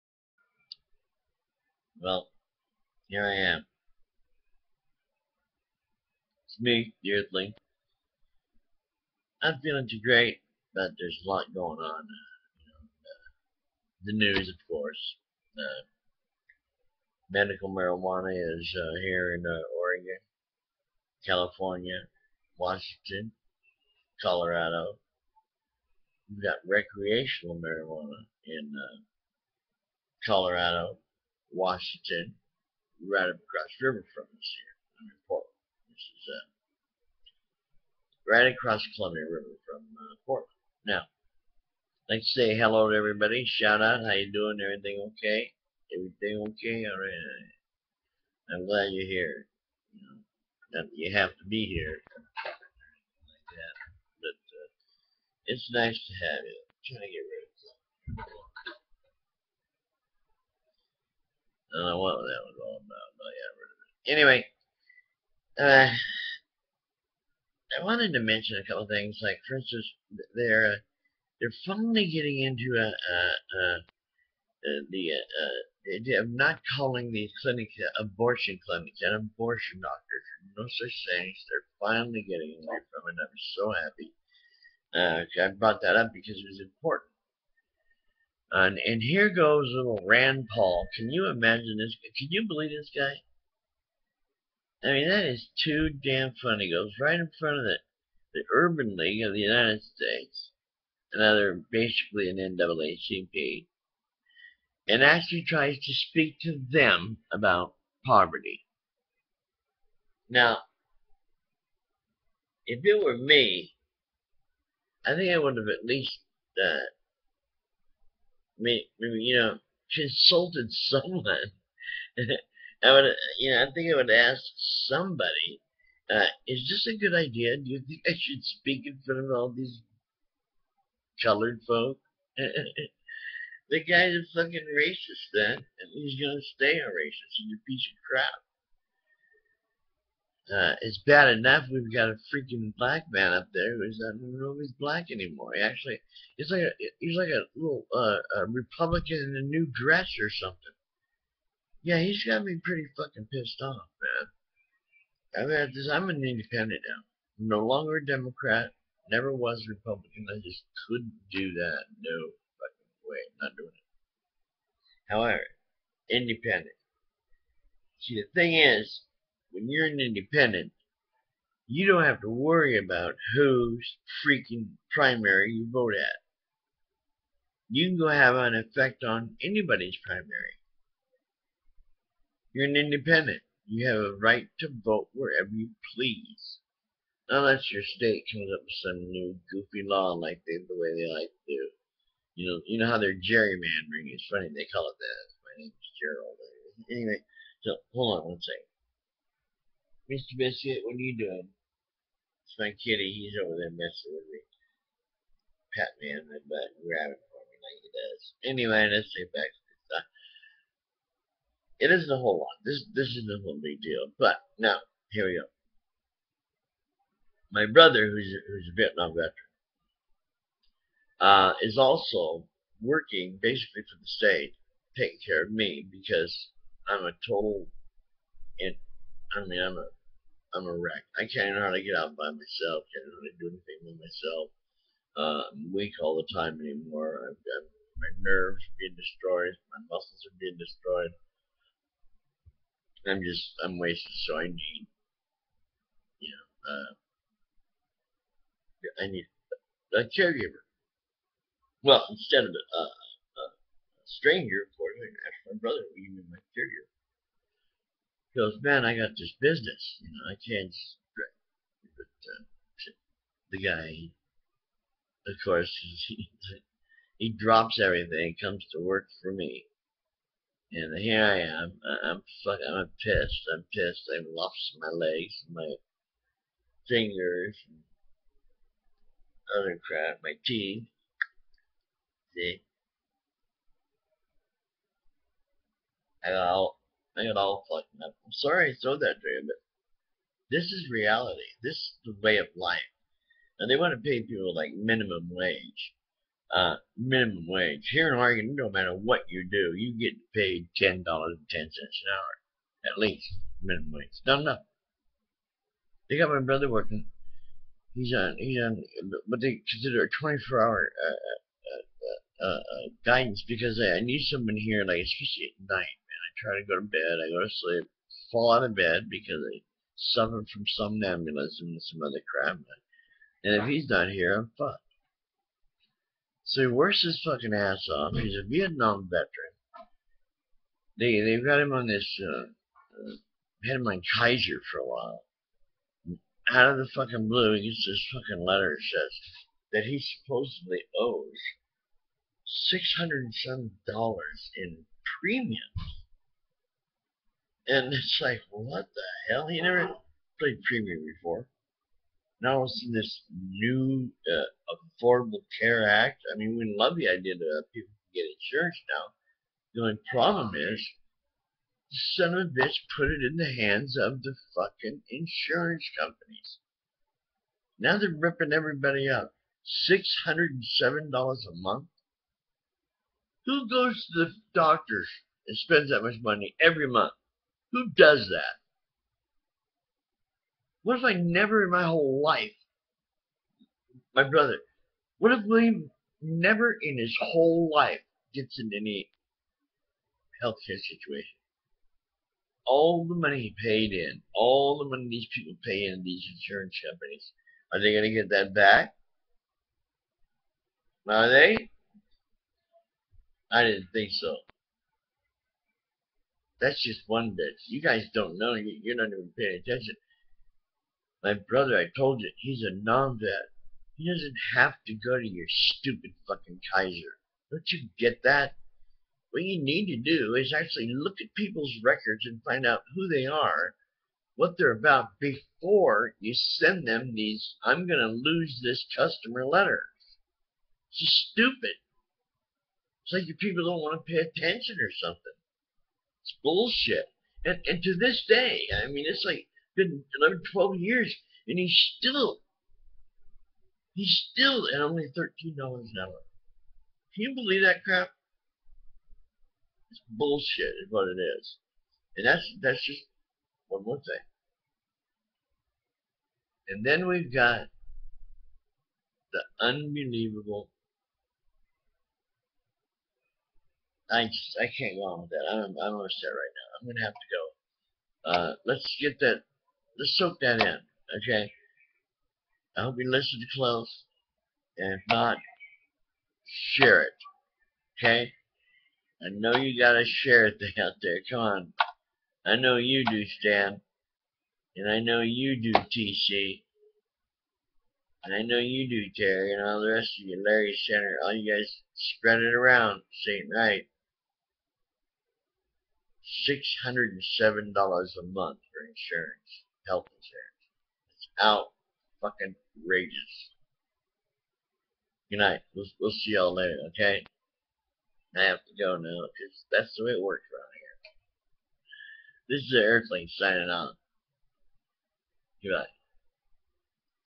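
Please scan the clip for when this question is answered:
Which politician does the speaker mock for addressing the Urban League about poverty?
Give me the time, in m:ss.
1:30.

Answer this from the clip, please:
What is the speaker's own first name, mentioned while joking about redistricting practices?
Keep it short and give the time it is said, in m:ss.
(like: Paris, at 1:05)
Gerald, at 3:15.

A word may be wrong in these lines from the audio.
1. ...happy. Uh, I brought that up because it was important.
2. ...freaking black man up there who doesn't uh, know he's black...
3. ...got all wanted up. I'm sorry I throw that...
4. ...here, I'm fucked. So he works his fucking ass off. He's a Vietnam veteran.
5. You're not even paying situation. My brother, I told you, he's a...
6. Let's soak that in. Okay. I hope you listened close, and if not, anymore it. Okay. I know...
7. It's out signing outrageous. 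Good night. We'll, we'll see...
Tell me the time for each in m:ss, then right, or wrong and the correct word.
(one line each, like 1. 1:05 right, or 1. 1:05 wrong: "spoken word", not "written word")
1. 1:23 right
2. 2:22 right
3. 4:47 wrong: "fucked", not "wanted"
4. 5:24 right
5. 6:48 wrong: "attention", not "situation"
6. 7:49 wrong: "share", not "anymore"
7. 8:21 wrong: "fucking", not "signing".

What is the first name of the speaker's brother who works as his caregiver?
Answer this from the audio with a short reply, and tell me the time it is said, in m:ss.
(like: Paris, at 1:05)
William, at 6:25.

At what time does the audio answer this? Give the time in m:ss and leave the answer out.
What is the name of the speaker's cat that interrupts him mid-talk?
3:20.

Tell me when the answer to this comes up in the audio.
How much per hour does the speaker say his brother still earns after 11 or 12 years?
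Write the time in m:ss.
7:25.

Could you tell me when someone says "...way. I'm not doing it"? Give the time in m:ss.
2:43.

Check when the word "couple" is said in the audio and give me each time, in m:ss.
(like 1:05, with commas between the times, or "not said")
1:08.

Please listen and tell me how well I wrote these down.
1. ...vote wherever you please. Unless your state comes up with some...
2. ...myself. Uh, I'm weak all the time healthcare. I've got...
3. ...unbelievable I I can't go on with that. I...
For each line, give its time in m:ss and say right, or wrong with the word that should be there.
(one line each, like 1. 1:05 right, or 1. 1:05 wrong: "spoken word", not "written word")
1. 3:04 right
2. 3:54 wrong: "anymore", not "healthcare"
3. 7:39 right.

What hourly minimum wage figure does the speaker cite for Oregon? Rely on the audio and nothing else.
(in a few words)
$10.10.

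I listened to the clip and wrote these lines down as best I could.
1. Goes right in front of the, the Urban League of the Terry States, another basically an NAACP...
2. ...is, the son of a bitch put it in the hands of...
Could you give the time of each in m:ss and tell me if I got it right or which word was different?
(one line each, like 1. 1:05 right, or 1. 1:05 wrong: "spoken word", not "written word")
1. 1:36 wrong: "United", not "Terry"
2. 6:00 right.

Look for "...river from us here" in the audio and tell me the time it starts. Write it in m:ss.
0:33.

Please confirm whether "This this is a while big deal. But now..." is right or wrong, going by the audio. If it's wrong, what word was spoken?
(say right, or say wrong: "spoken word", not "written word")
wrong: "whole", not "while".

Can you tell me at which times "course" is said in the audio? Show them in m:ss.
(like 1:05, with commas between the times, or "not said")
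0:14, 4:14, 4:25.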